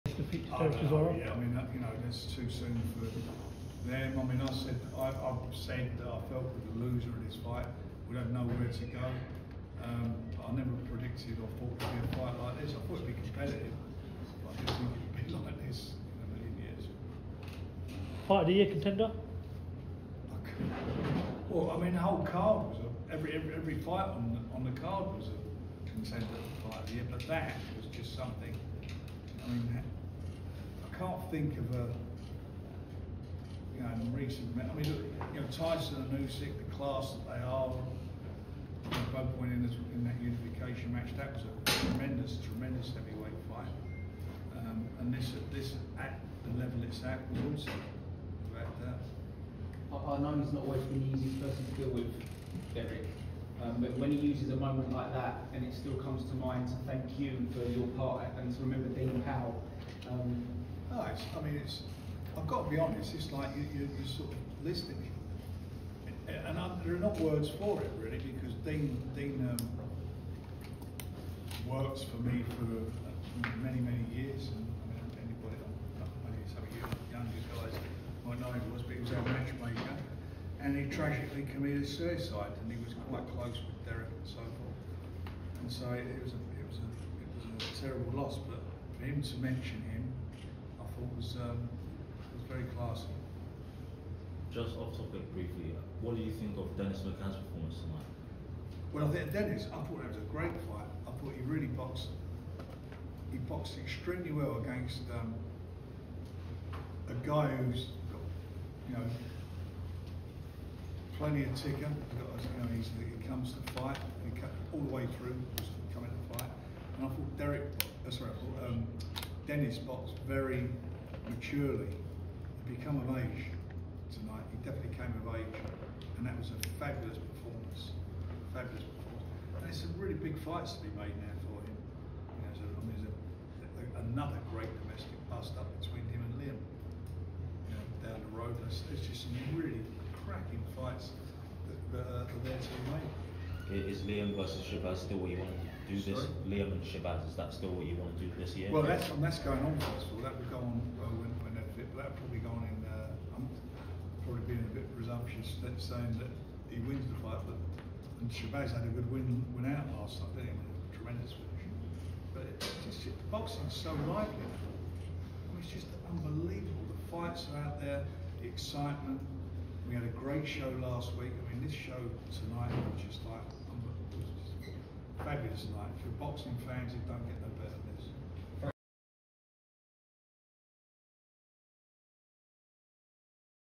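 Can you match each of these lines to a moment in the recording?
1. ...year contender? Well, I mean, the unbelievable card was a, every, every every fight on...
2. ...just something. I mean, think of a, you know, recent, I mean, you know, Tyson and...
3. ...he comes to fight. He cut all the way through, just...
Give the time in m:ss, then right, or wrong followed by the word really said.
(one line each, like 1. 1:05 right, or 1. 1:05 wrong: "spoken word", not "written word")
1. 0:18 wrong: "whole", not "unbelievable"
2. 0:27 right
3. 1:53 right.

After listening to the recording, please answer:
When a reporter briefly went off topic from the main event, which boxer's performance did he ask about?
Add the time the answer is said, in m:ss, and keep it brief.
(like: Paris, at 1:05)
Dennis McCann, at 1:36.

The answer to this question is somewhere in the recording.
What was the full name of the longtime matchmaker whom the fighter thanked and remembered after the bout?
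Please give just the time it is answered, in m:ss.
0:58.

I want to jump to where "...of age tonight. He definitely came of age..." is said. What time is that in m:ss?
2:03.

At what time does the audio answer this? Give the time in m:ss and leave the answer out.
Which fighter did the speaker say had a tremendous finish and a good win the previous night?
2:38.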